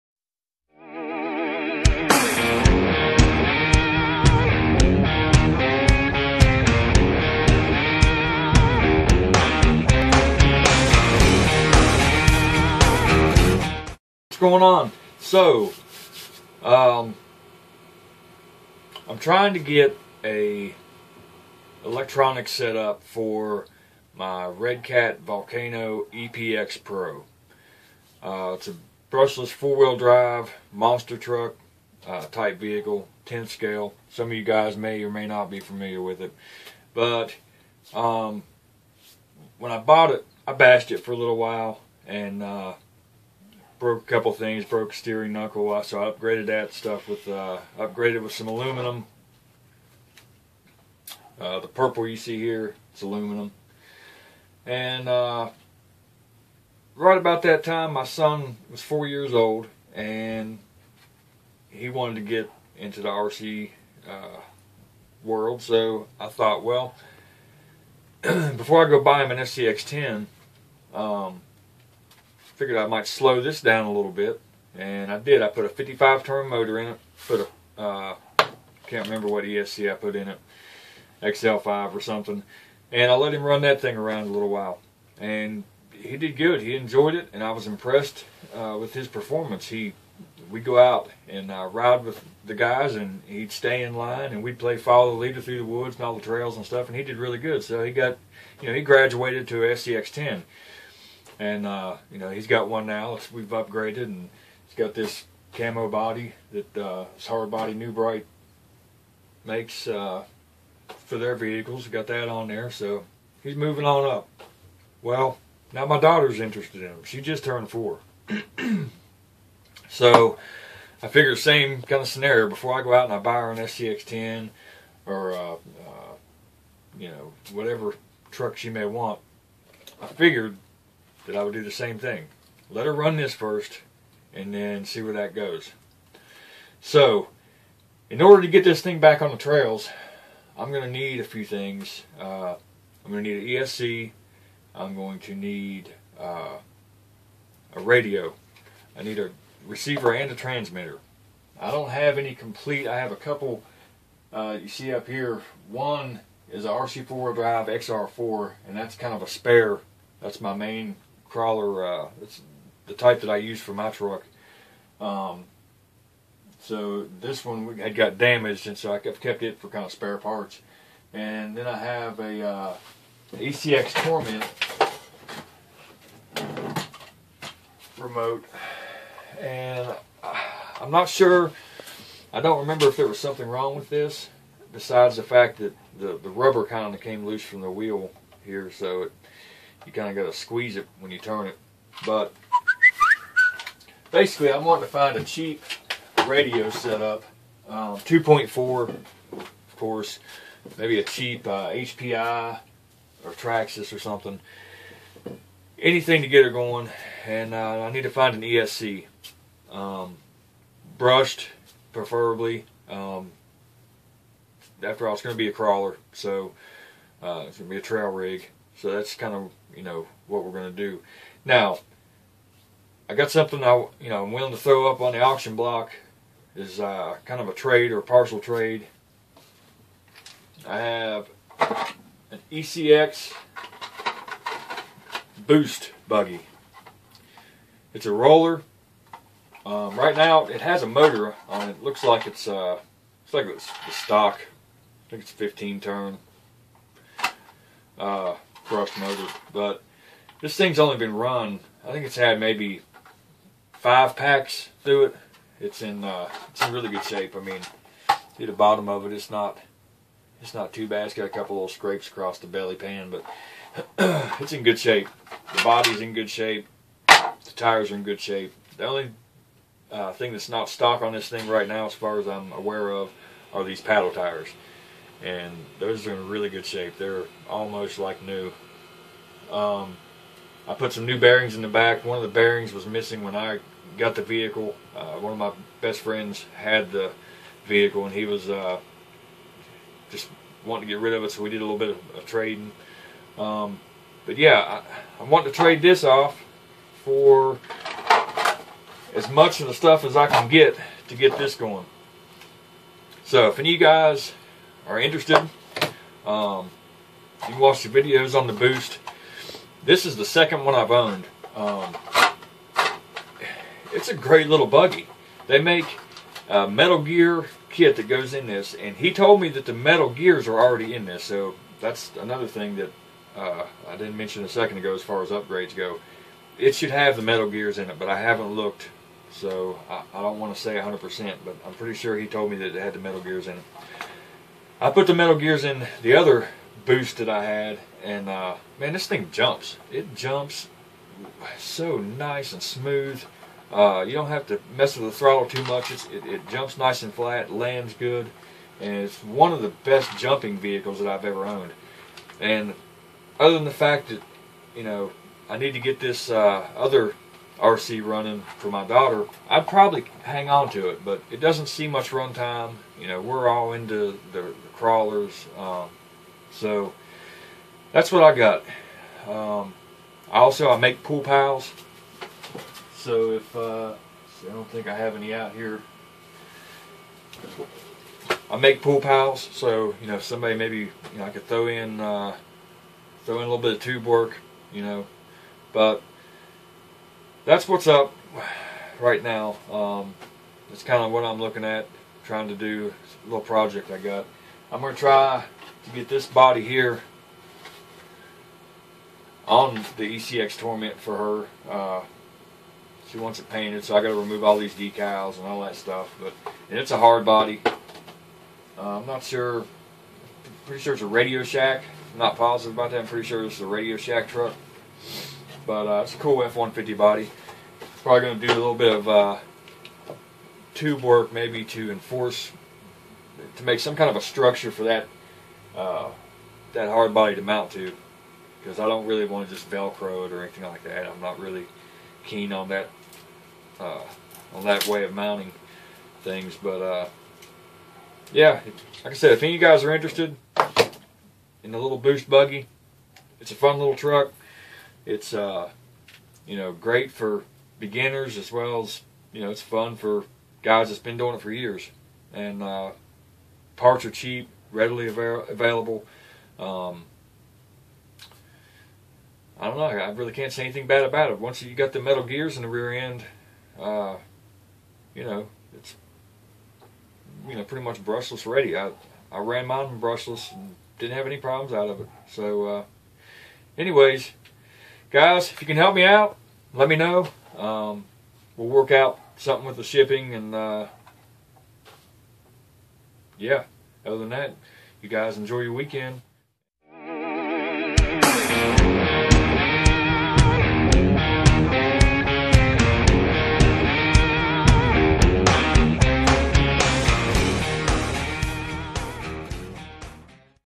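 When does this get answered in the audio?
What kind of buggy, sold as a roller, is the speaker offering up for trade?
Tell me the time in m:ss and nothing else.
3:52.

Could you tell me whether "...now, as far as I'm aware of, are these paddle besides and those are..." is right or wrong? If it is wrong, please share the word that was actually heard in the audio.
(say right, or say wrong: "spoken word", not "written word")
wrong: "tires", not "besides".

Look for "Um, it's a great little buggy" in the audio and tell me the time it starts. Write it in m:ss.
5:11.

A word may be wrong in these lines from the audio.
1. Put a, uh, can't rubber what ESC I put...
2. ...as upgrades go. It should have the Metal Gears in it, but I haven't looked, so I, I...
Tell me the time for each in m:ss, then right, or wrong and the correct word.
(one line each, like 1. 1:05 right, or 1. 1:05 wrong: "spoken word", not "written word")
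1. 1:17 wrong: "remember", not "rubber"
2. 5:25 right.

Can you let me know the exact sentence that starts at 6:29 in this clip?
Um, it's kind of what I'm looking at trying to do a little project I got.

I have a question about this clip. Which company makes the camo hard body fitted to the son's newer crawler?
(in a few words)
New Bright.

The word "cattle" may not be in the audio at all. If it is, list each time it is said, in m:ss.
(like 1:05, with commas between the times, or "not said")
not said.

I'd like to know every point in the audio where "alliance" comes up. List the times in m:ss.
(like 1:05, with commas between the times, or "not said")
not said.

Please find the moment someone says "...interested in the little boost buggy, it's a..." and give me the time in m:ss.
7:19.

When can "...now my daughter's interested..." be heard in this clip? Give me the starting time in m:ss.
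1:55.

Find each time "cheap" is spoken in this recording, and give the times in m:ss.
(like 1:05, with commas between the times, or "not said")
3:15, 3:21, 7:34.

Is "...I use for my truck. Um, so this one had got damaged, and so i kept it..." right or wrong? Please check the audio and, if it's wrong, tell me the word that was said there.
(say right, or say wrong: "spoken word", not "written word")
right.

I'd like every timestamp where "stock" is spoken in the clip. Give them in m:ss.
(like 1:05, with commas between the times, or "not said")
4:03, 4:30.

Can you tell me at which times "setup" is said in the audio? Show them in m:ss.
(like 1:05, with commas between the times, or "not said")
0:22, 3:16.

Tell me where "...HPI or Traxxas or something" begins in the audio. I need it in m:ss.
3:21.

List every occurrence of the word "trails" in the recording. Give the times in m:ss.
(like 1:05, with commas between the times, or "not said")
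1:36, 2:19, 3:37.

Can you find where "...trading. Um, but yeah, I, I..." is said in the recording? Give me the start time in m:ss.
4:52.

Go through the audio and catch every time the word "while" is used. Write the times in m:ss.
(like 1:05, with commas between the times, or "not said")
0:41, 1:24.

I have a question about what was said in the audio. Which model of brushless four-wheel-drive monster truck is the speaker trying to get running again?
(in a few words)
Redcat Volcano EPX Pro.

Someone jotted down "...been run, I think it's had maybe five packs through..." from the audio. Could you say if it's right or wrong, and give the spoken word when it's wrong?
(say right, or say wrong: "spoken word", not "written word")
right.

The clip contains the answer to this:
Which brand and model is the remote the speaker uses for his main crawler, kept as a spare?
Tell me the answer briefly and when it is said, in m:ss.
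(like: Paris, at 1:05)
RC4 drive XR4, at 2:36.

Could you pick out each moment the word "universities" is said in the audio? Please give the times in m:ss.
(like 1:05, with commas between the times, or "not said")
not said.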